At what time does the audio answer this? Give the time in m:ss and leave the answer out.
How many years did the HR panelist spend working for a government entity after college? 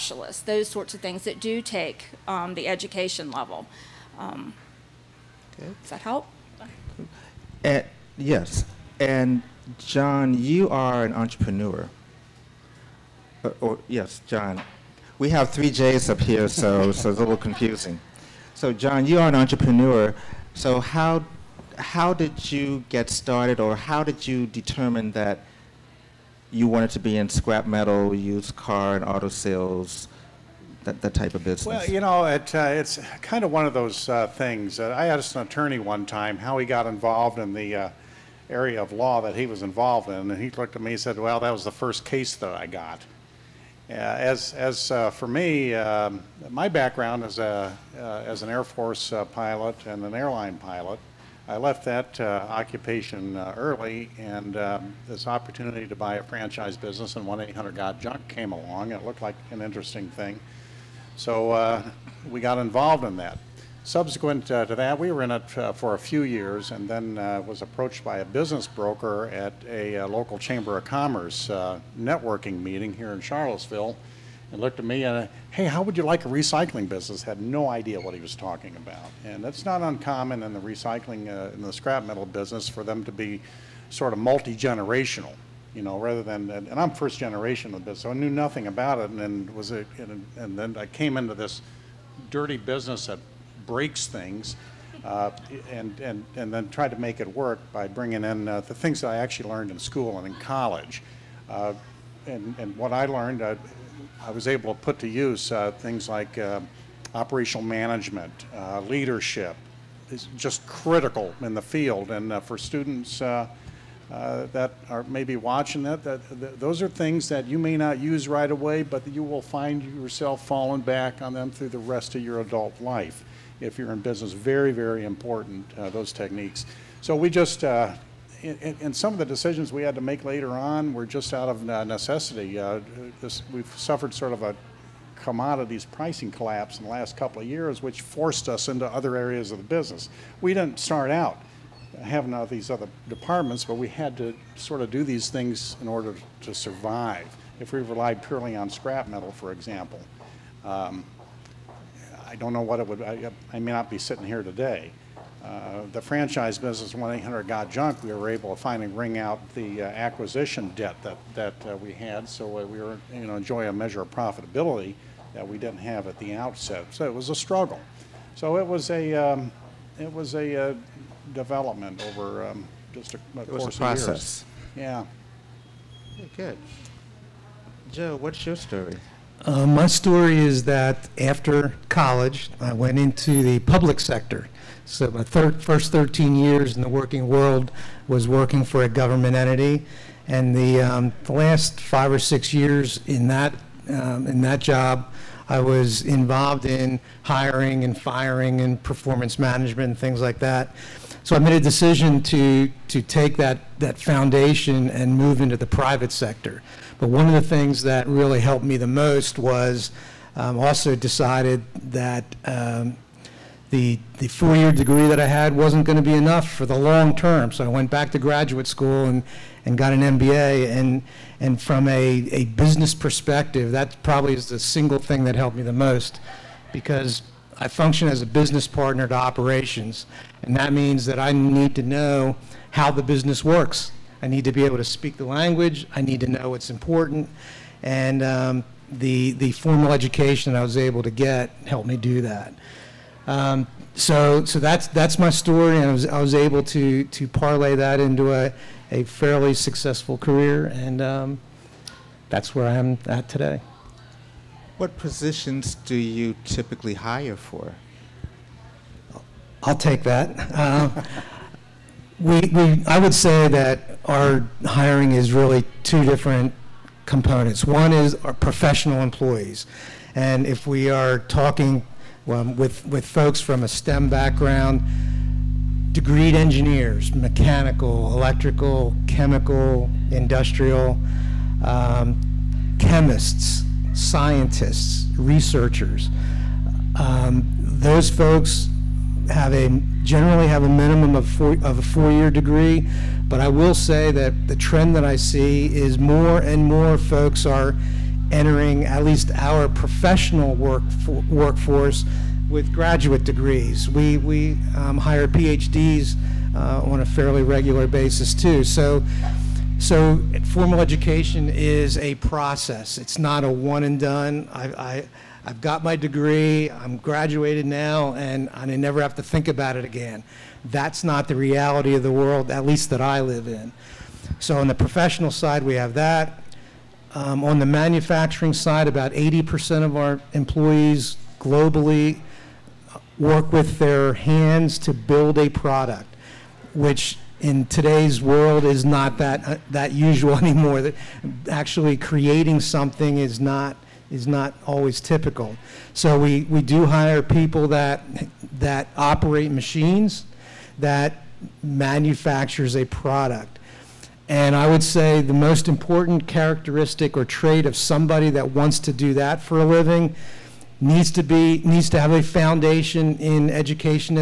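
3:05.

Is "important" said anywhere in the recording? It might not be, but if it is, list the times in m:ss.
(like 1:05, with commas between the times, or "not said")
2:05, 3:56, 5:55.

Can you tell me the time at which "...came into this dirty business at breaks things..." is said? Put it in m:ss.
1:30.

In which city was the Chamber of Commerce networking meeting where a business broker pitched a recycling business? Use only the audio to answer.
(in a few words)
Charlottesville.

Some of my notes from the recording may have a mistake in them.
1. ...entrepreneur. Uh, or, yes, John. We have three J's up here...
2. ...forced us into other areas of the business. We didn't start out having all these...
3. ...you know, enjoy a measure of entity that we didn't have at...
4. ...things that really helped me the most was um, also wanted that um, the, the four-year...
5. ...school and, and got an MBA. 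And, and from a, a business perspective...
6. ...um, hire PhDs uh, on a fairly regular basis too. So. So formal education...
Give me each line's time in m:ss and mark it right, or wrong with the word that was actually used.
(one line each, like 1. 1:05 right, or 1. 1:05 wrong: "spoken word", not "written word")
1. 0:11 right
2. 2:18 right
3. 2:43 wrong: "profitability", not "entity"
4. 3:27 wrong: "decided", not "wanted"
5. 3:38 right
6. 5:04 right.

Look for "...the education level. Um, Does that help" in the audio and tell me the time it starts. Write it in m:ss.
0:02.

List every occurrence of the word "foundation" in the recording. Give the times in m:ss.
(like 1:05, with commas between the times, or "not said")
3:23, 6:02.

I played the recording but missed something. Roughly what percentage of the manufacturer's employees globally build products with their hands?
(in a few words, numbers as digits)
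80%.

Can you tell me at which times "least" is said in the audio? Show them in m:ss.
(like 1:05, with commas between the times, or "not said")
4:59, 5:22.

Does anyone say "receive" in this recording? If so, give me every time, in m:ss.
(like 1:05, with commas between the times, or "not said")
not said.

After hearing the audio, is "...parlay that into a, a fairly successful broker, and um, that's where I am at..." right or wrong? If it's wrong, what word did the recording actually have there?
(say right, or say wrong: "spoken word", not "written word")
wrong: "career", not "broker".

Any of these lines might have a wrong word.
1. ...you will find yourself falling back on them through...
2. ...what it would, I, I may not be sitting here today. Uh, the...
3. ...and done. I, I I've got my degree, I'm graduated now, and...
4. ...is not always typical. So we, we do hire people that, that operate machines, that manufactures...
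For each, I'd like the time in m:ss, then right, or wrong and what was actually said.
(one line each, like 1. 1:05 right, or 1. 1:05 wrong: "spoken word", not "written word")
1. 1:59 right
2. 2:32 right
3. 5:13 right
4. 5:44 right.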